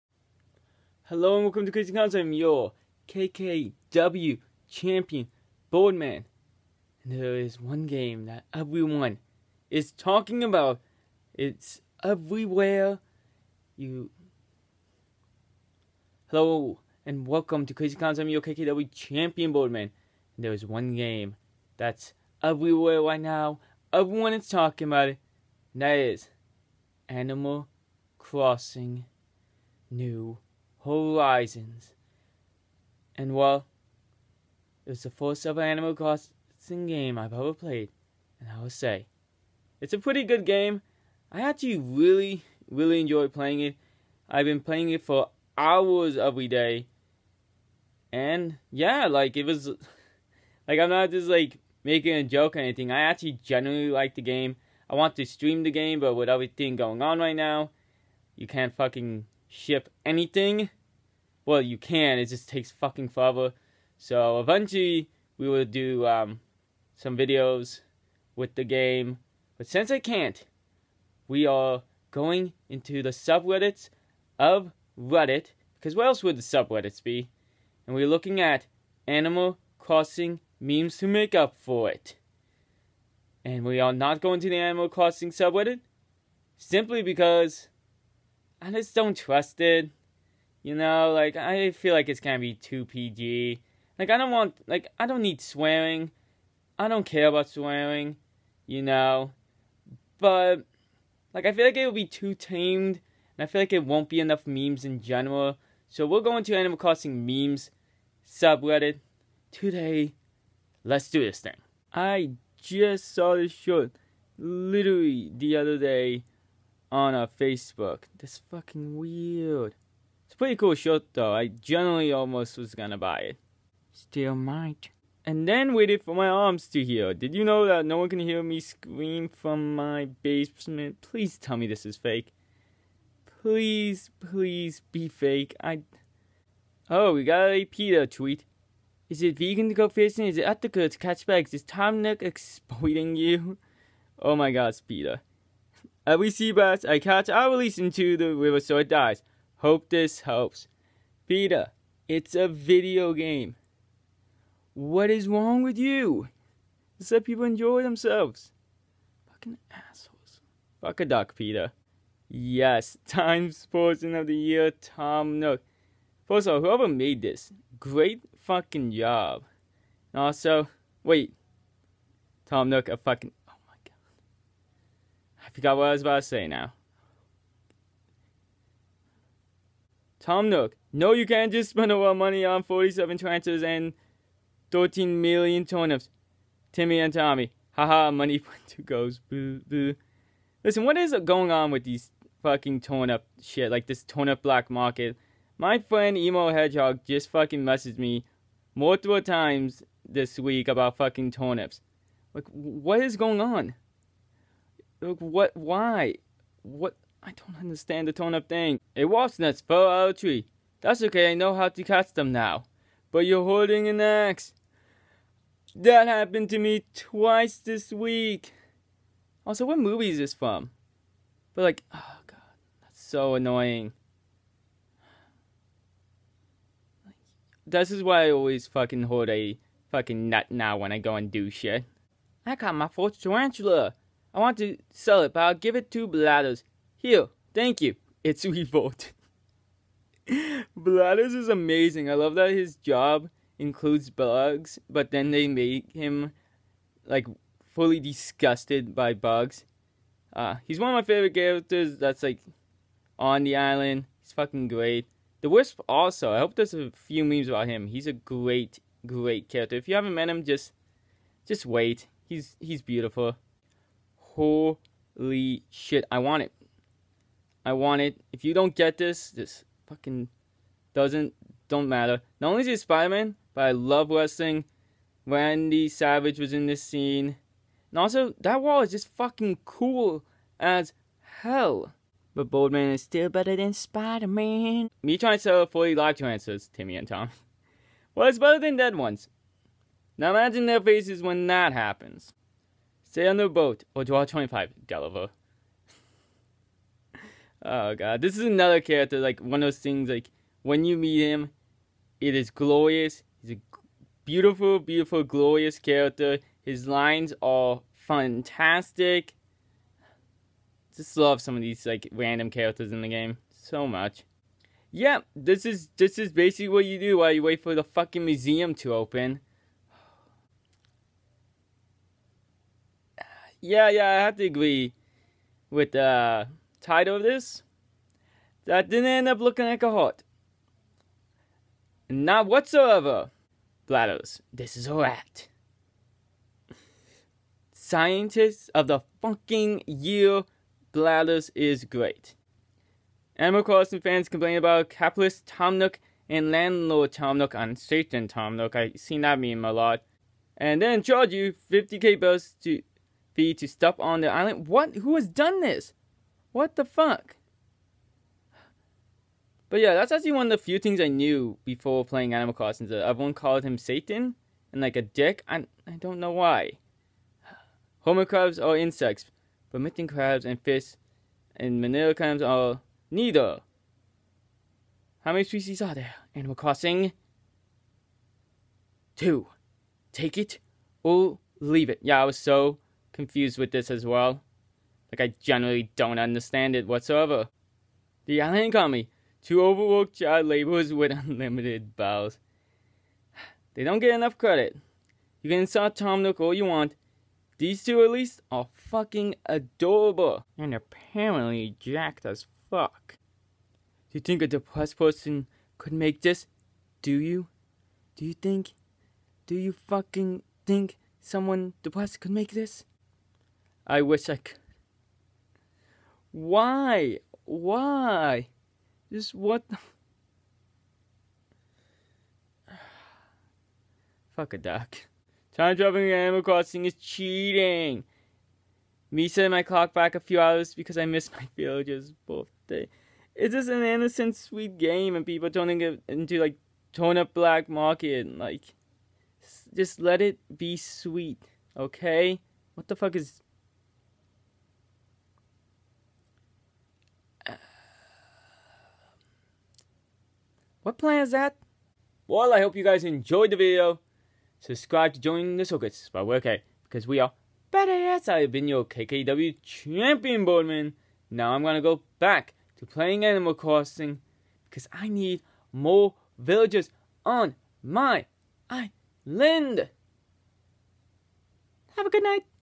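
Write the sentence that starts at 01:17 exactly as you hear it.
And we're looking at Animal Crossing memes to make up for it.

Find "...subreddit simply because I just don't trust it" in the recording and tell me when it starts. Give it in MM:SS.
01:25.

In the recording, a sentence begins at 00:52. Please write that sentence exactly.
I actually genuinely like the game.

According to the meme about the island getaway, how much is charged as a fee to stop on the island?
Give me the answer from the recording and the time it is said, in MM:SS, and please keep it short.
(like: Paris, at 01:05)
50k, at 05:51.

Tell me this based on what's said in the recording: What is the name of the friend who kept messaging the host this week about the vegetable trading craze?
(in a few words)
Emo Hedgehog.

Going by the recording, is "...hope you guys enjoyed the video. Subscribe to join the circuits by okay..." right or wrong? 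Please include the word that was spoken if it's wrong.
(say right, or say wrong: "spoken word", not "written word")
right.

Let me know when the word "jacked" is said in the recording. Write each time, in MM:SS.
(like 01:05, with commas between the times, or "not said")
06:41.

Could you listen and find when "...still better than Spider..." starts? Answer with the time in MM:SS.
04:43.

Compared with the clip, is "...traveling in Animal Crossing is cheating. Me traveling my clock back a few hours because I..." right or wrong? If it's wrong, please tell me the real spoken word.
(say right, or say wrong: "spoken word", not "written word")
wrong: "setting", not "traveling".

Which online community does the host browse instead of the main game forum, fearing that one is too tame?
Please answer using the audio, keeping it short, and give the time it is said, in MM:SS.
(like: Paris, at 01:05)
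Animal Crossing memes subreddit, at 01:46.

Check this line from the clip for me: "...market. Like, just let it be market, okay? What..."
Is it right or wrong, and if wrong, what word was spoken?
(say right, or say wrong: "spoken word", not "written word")
wrong: "sweet", not "market".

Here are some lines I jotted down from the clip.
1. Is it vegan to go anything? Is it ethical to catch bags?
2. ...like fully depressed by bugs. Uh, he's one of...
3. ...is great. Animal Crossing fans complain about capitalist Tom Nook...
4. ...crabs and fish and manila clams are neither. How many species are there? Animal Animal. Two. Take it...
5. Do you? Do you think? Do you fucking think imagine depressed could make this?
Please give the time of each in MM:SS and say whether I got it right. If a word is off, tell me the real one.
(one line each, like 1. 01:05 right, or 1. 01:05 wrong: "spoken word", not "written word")
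1. 02:19 wrong: "fishing", not "anything"
2. 04:07 wrong: "disgusted", not "depressed"
3. 05:41 right
4. 06:10 wrong: "Crossing", not "Animal"
5. 06:47 wrong: "someone", not "imagine".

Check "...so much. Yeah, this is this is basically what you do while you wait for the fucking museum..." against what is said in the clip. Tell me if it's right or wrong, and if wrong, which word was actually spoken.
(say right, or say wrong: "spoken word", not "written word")
right.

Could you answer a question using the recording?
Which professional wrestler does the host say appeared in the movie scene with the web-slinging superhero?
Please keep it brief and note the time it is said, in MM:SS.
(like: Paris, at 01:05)
Randy Savage, at 04:35.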